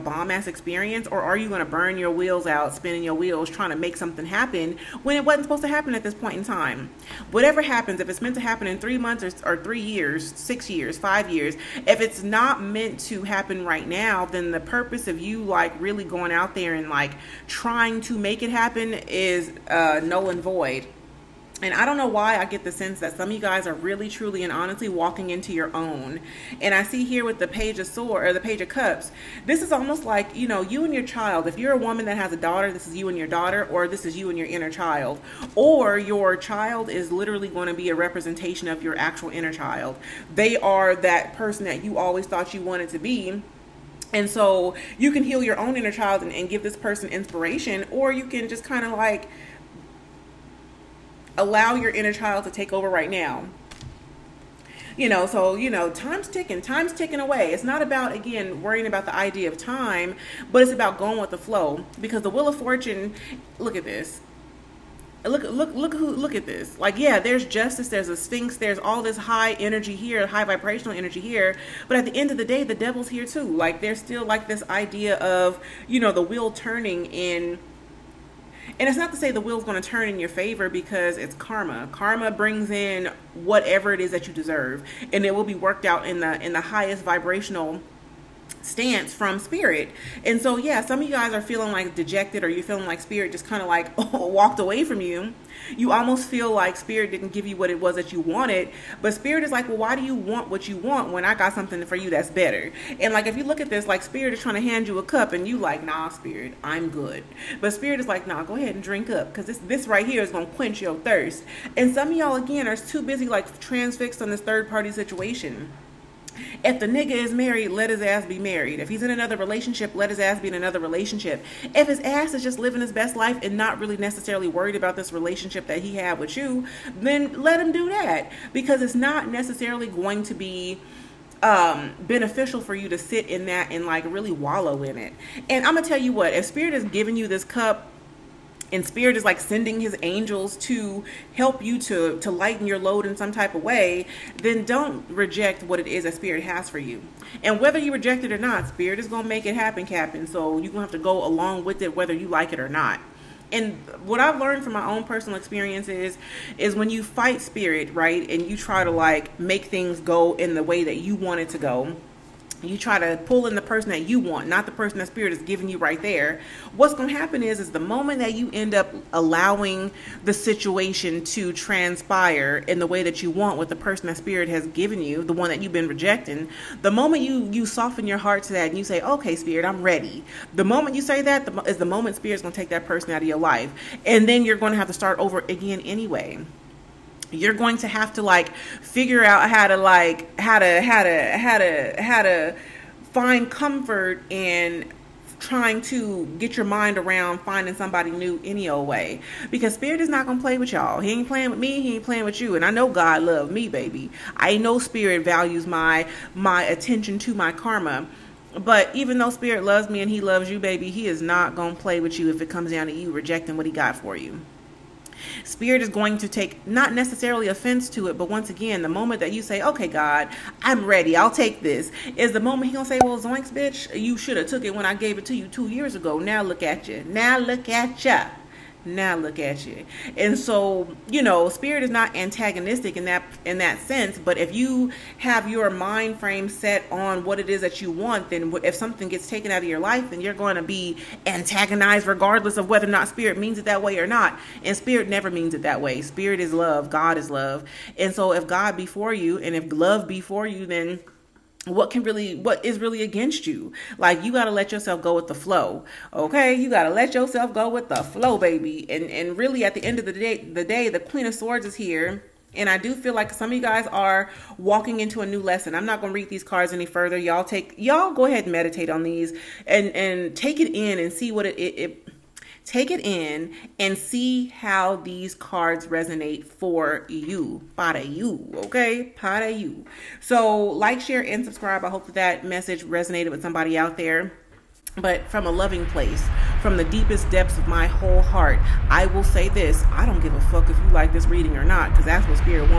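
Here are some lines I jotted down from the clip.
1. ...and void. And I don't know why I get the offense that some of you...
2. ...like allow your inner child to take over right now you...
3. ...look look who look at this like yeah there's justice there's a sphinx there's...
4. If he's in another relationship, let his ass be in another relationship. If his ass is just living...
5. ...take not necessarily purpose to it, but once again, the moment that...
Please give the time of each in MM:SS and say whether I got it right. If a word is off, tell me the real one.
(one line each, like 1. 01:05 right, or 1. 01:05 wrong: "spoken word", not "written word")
1. 00:20 wrong: "sense", not "offense"
2. 00:48 right
3. 01:05 right
4. 01:58 right
5. 03:36 wrong: "offense", not "purpose".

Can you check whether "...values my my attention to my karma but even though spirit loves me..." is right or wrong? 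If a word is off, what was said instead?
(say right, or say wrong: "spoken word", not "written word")
right.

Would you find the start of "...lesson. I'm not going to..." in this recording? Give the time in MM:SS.
04:25.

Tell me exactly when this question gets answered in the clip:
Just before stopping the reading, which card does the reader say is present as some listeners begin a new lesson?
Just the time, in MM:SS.
04:20.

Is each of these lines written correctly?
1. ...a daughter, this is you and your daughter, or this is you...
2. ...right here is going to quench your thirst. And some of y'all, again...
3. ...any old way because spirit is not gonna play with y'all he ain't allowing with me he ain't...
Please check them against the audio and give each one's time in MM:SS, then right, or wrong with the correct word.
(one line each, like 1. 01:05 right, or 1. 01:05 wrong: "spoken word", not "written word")
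1. 00:32 right
2. 01:49 right
3. 03:18 wrong: "playing", not "allowing".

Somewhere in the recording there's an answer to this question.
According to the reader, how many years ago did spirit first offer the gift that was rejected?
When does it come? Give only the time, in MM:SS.
03:45.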